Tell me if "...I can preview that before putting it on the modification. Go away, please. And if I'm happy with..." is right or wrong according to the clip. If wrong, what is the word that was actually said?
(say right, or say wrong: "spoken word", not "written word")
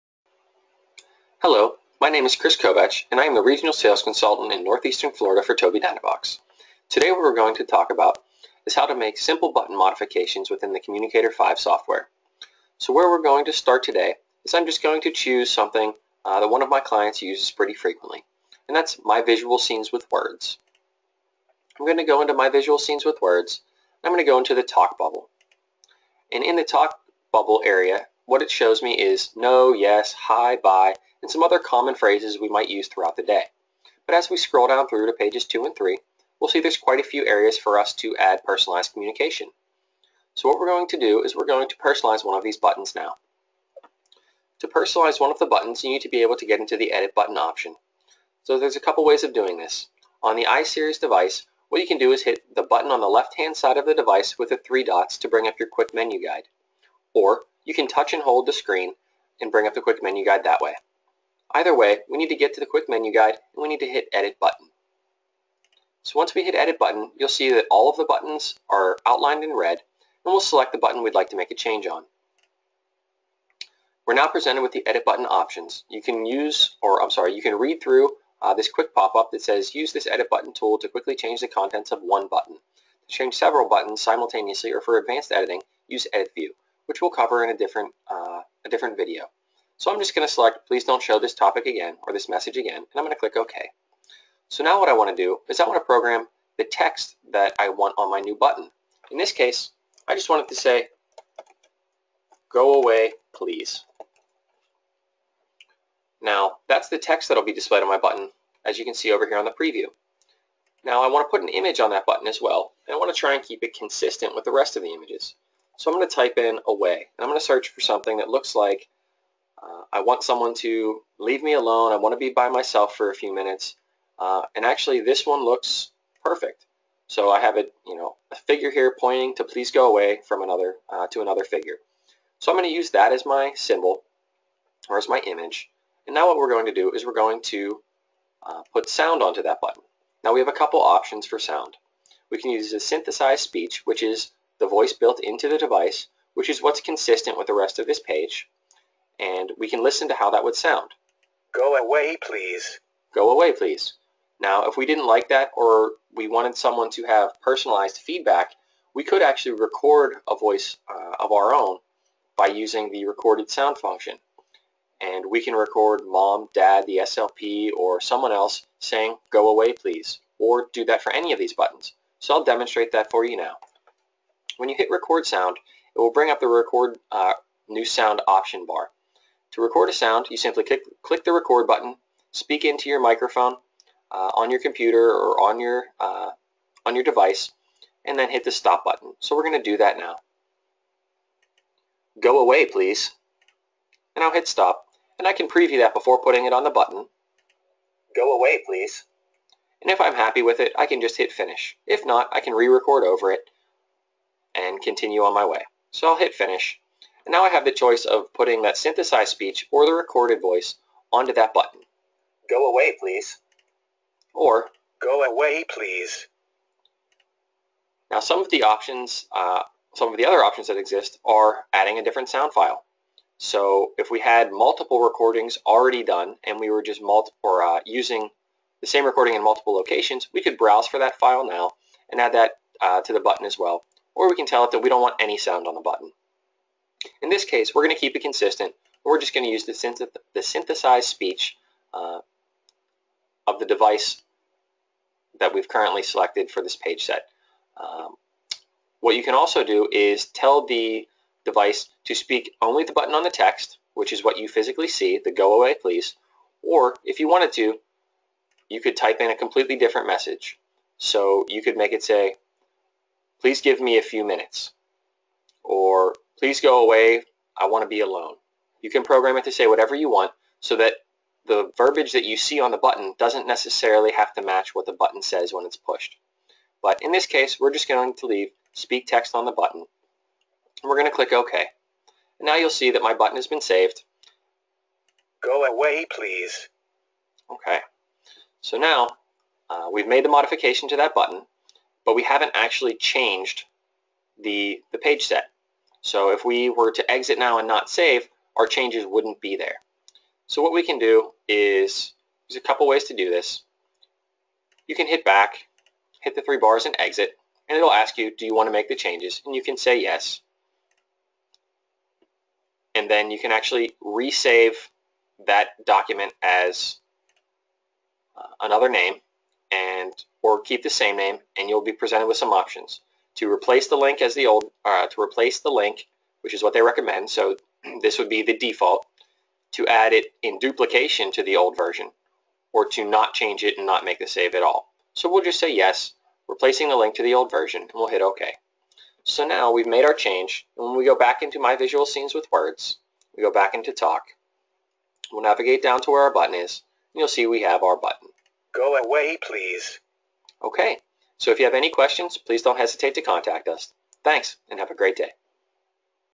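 wrong: "button", not "modification".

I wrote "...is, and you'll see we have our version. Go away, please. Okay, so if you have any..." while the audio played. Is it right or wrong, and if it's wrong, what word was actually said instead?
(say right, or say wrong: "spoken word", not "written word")
wrong: "button", not "version".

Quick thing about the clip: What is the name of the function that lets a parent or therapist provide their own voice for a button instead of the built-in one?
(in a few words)
recorded sound.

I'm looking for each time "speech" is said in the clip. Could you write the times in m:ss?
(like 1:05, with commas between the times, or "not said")
2:23, 3:29, 4:01.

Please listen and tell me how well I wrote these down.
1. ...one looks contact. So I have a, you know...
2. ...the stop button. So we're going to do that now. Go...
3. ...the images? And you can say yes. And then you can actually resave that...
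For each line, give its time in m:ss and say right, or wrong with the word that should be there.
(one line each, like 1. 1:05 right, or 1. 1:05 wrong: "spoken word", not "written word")
1. 2:05 wrong: "perfect", not "contact"
2. 3:08 right
3. 5:08 wrong: "changes", not "images".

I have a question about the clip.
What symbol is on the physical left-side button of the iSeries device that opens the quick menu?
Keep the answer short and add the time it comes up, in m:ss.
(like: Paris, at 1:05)
three dots, at 0:54.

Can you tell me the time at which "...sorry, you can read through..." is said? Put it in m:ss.
1:17.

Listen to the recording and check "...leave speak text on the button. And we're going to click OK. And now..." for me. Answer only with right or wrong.
right.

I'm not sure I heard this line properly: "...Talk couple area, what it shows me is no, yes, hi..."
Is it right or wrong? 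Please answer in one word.
wrong.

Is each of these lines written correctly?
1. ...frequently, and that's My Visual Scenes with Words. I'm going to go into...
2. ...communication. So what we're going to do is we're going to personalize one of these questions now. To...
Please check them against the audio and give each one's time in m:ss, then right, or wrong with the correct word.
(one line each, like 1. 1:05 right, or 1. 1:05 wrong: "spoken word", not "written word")
1. 0:17 right
2. 0:38 wrong: "buttons", not "questions".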